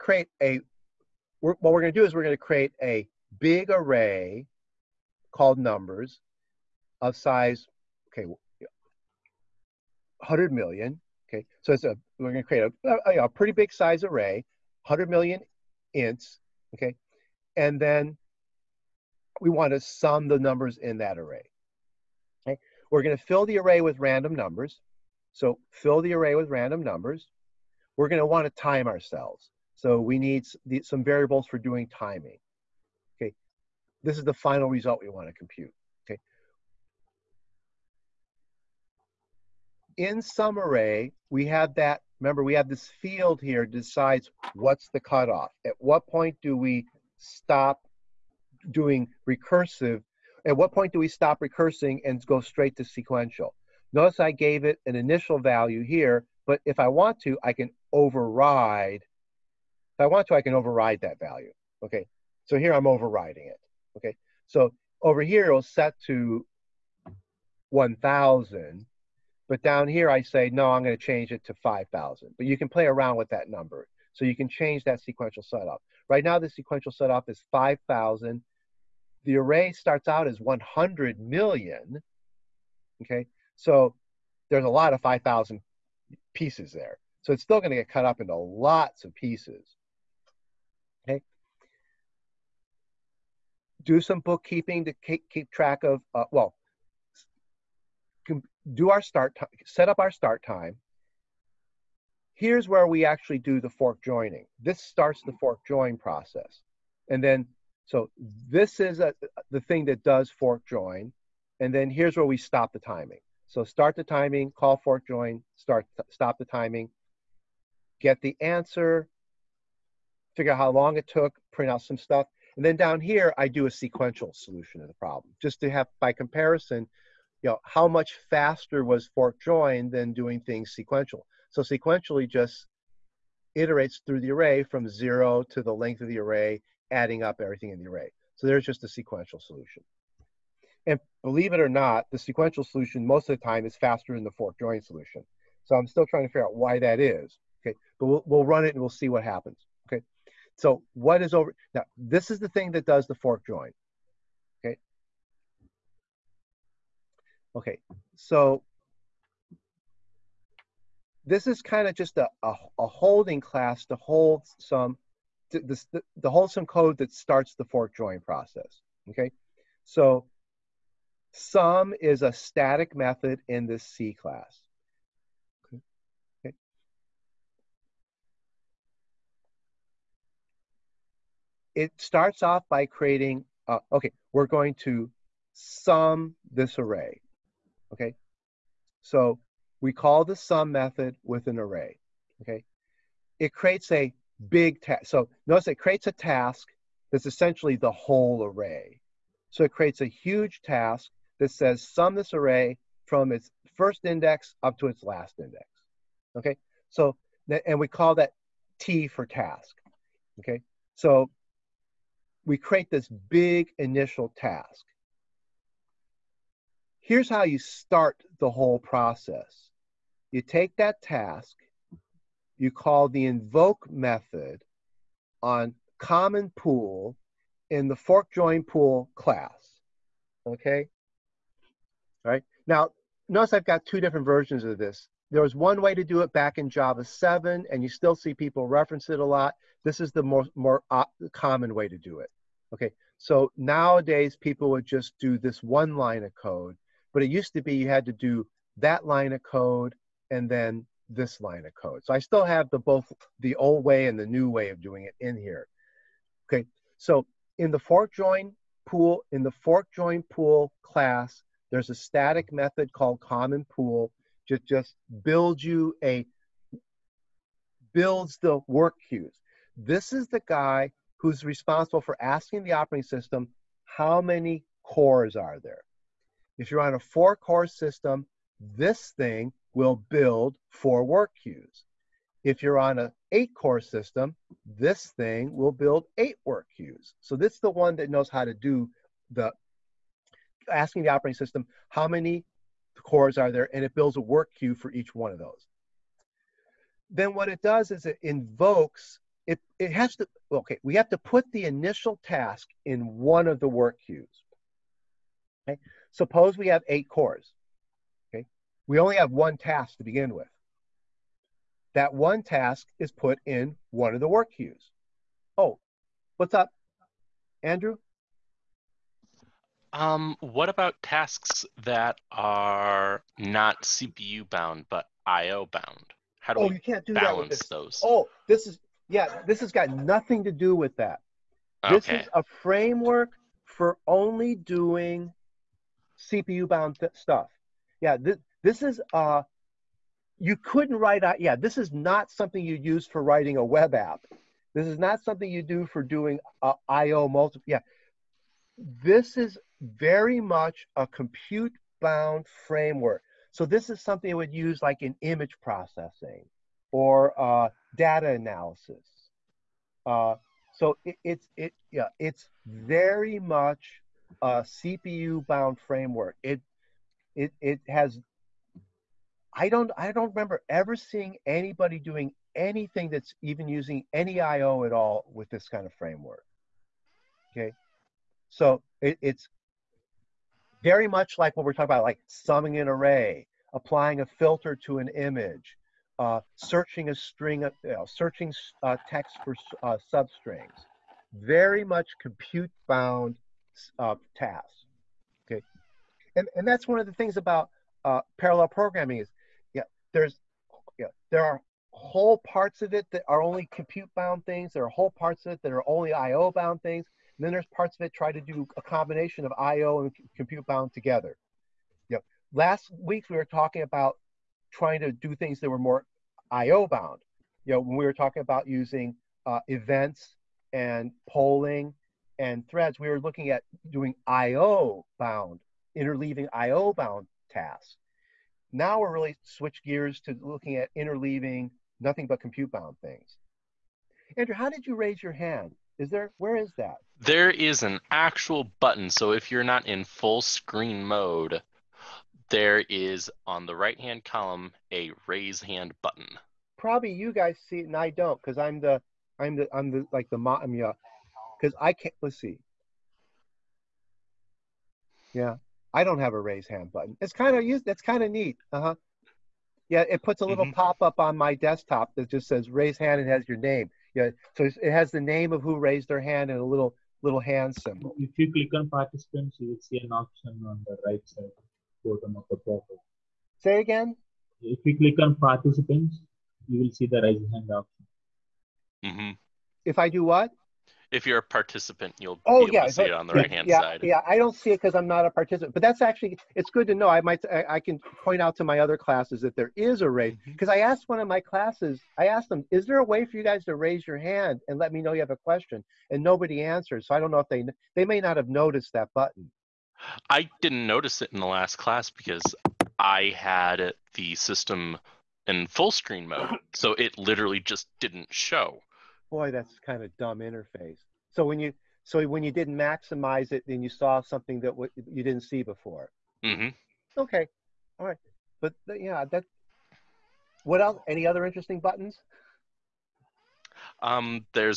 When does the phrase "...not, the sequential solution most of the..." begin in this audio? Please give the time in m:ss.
2:21.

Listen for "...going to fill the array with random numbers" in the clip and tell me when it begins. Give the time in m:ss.
0:23.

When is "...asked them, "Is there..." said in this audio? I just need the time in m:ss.
8:12.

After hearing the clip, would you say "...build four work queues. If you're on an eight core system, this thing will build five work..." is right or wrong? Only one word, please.
wrong.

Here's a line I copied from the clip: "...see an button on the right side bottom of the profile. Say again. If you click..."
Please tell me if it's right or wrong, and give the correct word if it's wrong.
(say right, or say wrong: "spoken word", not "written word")
wrong: "option", not "button".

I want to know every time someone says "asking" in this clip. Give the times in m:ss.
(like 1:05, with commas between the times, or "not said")
4:32, 4:50.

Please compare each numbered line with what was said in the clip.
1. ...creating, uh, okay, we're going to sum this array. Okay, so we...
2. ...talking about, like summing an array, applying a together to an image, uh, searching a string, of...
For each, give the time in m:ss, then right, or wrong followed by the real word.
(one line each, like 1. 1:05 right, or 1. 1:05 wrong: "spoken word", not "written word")
1. 3:02 right
2. 6:21 wrong: "filter", not "together".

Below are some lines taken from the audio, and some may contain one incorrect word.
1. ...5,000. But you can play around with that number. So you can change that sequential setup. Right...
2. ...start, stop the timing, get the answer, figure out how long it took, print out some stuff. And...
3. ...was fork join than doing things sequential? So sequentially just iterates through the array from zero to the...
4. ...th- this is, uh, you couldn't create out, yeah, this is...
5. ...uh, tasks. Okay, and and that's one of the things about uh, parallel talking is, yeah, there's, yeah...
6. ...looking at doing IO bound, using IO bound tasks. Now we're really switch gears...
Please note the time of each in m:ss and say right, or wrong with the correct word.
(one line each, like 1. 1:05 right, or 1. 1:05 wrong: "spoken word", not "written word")
1. 1:11 right
2. 1:55 right
3. 2:08 right
4. 5:38 wrong: "write", not "create"
5. 6:33 wrong: "programming", not "talking"
6. 7:03 wrong: "interleaving", not "using".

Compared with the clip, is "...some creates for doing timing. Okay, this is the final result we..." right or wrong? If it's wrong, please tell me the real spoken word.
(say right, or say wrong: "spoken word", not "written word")
wrong: "variables", not "creates".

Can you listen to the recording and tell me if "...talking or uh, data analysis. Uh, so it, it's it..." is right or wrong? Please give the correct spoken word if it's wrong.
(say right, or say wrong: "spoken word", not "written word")
wrong: "processing", not "talking".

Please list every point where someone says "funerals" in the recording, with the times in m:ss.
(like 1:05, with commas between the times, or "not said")
not said.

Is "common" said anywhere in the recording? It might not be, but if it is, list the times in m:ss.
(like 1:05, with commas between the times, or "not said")
3:45, 4:01, 4:23.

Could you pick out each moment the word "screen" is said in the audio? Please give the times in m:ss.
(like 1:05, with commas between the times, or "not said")
7:20, 8:25.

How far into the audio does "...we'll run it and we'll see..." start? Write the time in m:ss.
2:28.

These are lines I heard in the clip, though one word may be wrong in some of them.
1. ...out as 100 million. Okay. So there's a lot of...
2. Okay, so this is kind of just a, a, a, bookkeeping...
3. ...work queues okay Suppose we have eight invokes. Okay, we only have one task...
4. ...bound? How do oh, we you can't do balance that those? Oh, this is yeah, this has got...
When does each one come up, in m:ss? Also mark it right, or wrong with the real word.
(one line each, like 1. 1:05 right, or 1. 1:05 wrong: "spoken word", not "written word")
1. 1:20 right
2. 2:37 wrong: "holding", not "bookkeeping"
3. 5:03 wrong: "cores", not "invokes"
4. 5:25 right.